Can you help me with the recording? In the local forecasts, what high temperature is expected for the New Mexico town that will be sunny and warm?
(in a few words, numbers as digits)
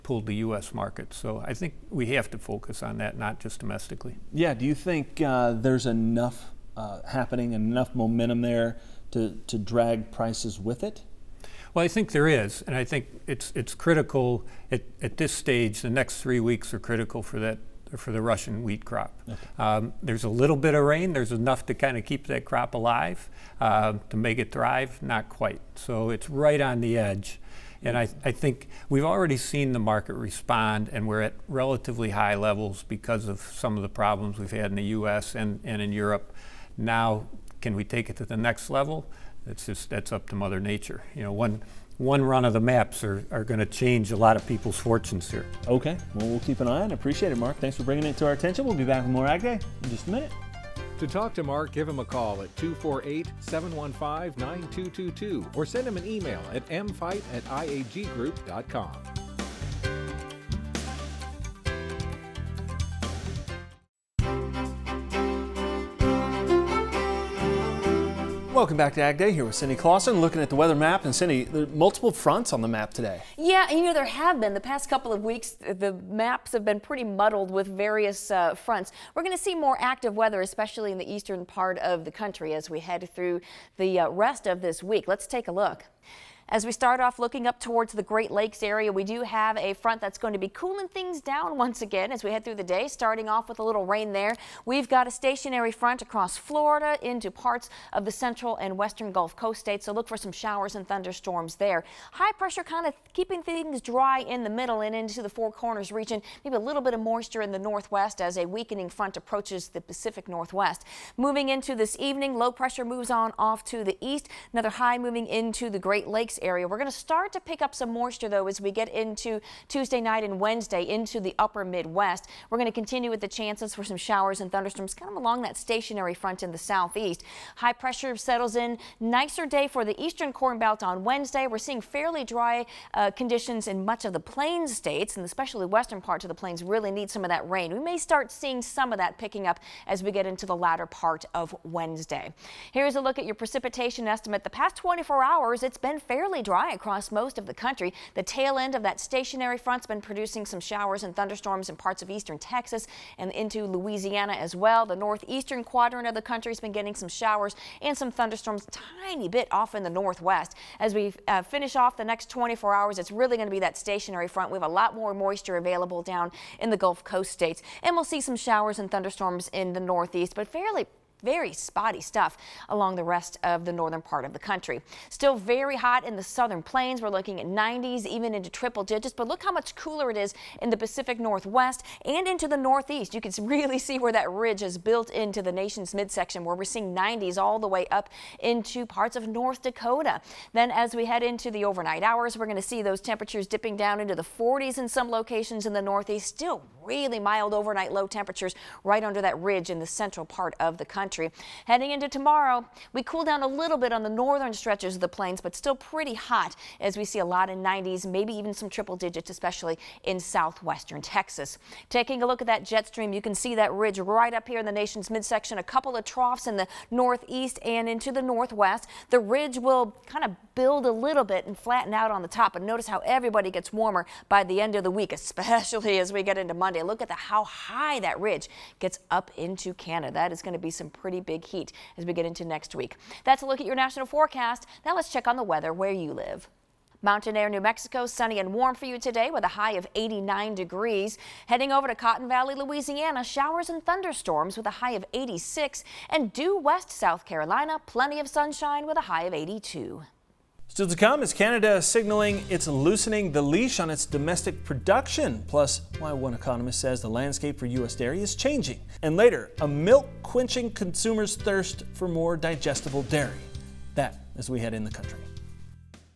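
89 degrees.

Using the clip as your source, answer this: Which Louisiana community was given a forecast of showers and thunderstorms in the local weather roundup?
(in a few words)
Cotton Valley.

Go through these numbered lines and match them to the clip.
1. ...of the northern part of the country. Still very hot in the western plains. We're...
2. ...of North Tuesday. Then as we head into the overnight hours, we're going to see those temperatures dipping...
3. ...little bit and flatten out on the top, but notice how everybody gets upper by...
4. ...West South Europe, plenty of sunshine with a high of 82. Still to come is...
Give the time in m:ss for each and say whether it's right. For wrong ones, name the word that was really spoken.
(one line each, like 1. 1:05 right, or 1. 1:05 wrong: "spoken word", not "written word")
1. 2:53 wrong: "southern", not "western"
2. 3:09 wrong: "Dakota", not "Tuesday"
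3. 3:40 wrong: "warmer", not "upper"
4. 4:06 wrong: "Carolina", not "Europe".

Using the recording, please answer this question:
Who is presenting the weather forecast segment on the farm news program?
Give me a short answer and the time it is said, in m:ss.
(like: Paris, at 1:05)
Cindy Clausen, at 1:09.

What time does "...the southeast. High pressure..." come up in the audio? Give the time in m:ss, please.
2:06.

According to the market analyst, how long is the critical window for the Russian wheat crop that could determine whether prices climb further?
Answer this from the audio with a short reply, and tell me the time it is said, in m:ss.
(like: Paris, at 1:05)
3 weeks, at 0:15.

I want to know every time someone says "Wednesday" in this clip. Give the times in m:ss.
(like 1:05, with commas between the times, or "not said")
2:00, 2:11, 2:21.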